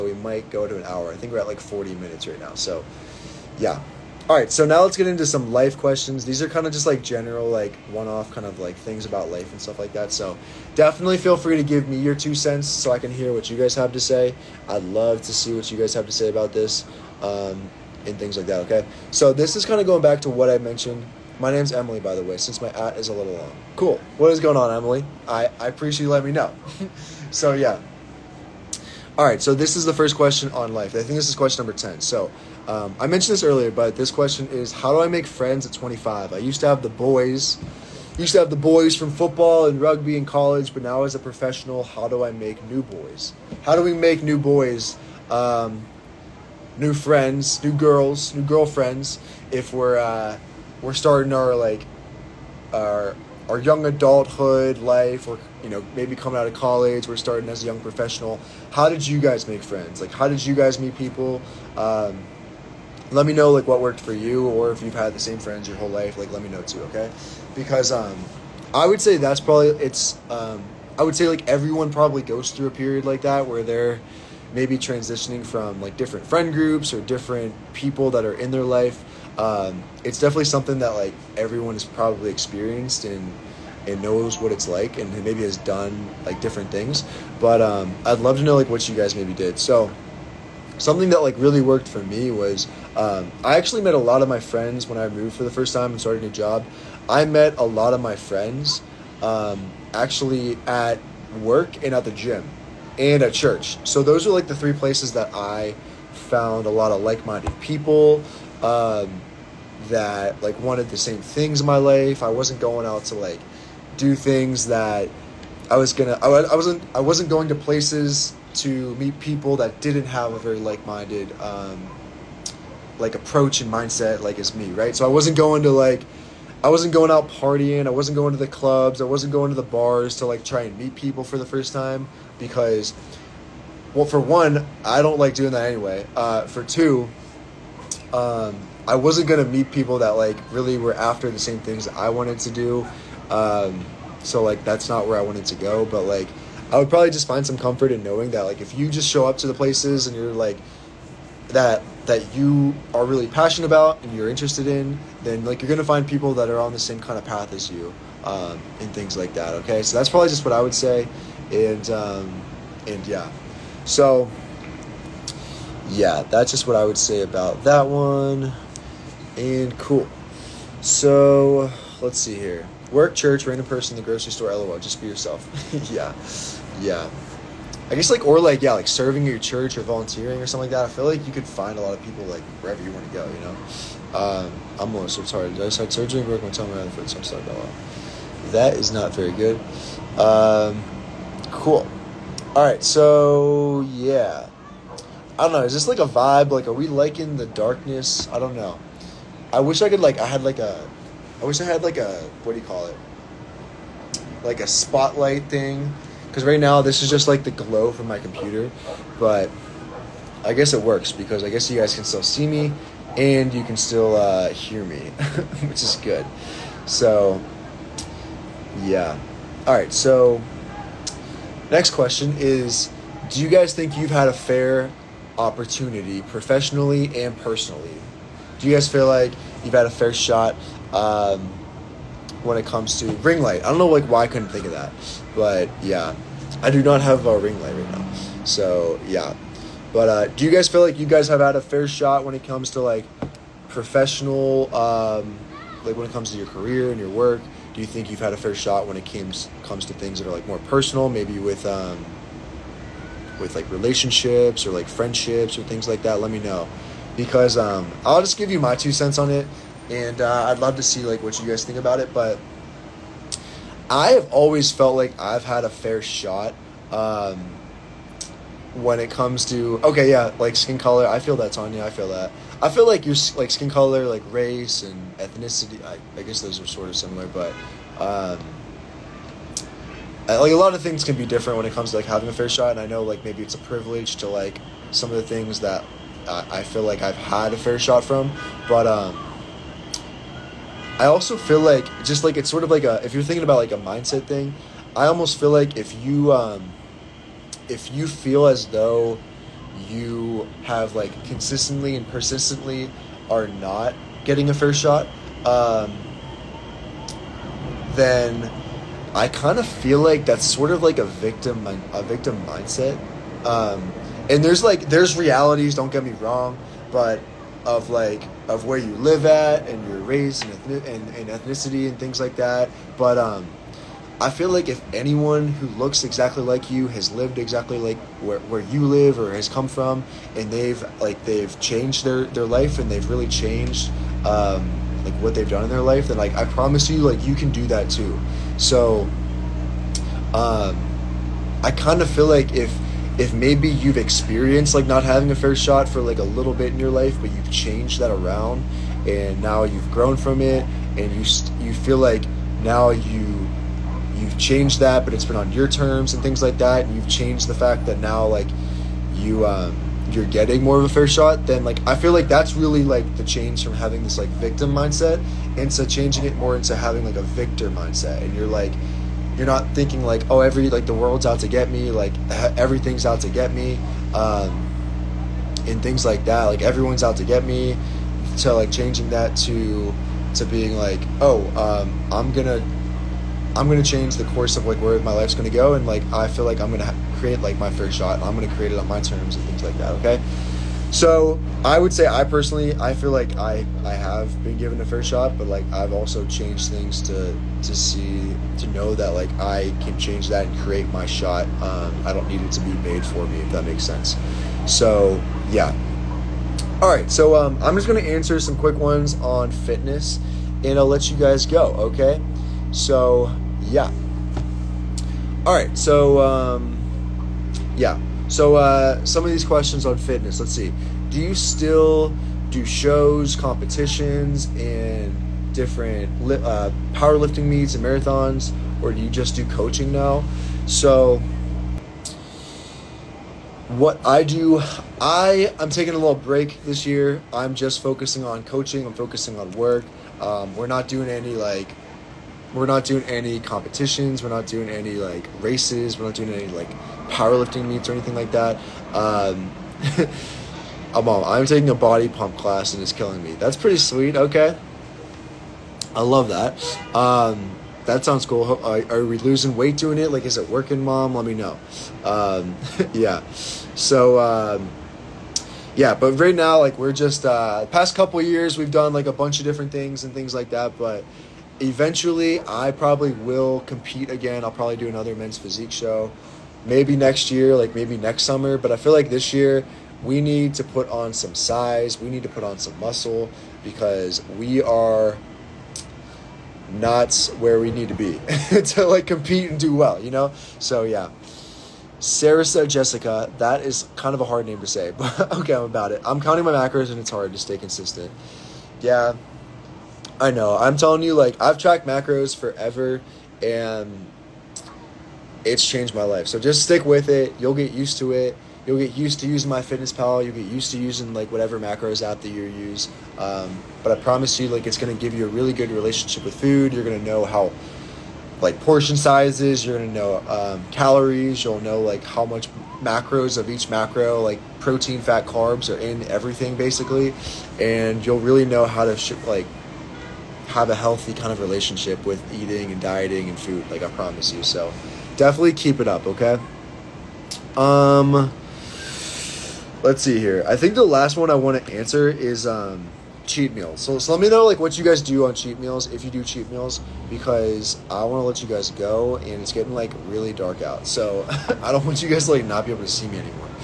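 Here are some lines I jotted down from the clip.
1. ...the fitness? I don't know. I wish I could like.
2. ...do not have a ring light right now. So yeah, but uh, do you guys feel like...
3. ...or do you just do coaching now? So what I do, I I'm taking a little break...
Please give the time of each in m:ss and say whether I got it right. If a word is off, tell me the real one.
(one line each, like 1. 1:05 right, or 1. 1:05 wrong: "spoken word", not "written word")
1. 3:17 wrong: "darkness", not "fitness"
2. 3:56 right
3. 7:08 right.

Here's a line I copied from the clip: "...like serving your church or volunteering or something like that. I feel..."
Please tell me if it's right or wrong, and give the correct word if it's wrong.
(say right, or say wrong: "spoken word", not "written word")
right.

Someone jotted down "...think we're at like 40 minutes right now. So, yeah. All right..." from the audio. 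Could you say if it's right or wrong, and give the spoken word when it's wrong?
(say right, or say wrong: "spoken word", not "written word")
right.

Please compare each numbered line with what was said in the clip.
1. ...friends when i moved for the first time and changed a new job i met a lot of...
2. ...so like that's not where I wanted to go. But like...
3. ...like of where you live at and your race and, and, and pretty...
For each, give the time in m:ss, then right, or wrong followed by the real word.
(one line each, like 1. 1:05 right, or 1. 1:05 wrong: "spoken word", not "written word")
1. 1:34 wrong: "started", not "changed"
2. 2:24 right
3. 5:17 wrong: "ethnicity", not "pretty".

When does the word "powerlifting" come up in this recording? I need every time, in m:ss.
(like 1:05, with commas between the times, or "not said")
7:06, 7:27.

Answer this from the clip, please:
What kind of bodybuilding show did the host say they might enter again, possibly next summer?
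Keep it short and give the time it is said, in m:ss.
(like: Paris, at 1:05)
men's physique, at 7:55.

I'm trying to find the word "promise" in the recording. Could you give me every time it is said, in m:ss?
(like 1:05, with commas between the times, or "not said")
5:36, 8:34, 8:53.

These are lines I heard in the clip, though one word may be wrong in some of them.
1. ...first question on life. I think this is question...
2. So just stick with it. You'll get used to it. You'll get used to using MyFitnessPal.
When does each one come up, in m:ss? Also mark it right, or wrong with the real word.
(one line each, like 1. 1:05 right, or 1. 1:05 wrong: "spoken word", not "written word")
1. 0:29 right
2. 8:26 right.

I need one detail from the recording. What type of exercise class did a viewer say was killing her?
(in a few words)
body pump.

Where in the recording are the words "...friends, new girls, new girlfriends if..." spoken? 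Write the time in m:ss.
0:46.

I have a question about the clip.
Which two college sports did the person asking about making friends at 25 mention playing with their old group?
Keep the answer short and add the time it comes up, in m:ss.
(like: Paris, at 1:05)
football and rugby, at 0:39.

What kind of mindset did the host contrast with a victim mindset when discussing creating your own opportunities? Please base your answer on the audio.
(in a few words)
victor mindset.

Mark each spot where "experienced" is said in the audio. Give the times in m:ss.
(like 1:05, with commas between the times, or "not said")
1:22, 5:43.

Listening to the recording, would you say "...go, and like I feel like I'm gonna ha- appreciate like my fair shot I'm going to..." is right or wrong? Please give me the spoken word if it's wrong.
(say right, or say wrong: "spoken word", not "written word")
wrong: "create", not "appreciate".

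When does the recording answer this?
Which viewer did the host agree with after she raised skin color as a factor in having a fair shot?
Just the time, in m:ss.
4:31.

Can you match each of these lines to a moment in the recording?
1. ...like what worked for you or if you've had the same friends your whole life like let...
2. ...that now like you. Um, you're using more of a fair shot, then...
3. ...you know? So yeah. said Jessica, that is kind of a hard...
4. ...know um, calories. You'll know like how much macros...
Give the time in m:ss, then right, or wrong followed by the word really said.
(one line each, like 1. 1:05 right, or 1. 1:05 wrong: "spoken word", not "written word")
1. 1:03 right
2. 5:57 wrong: "getting", not "using"
3. 8:10 right
4. 8:39 right.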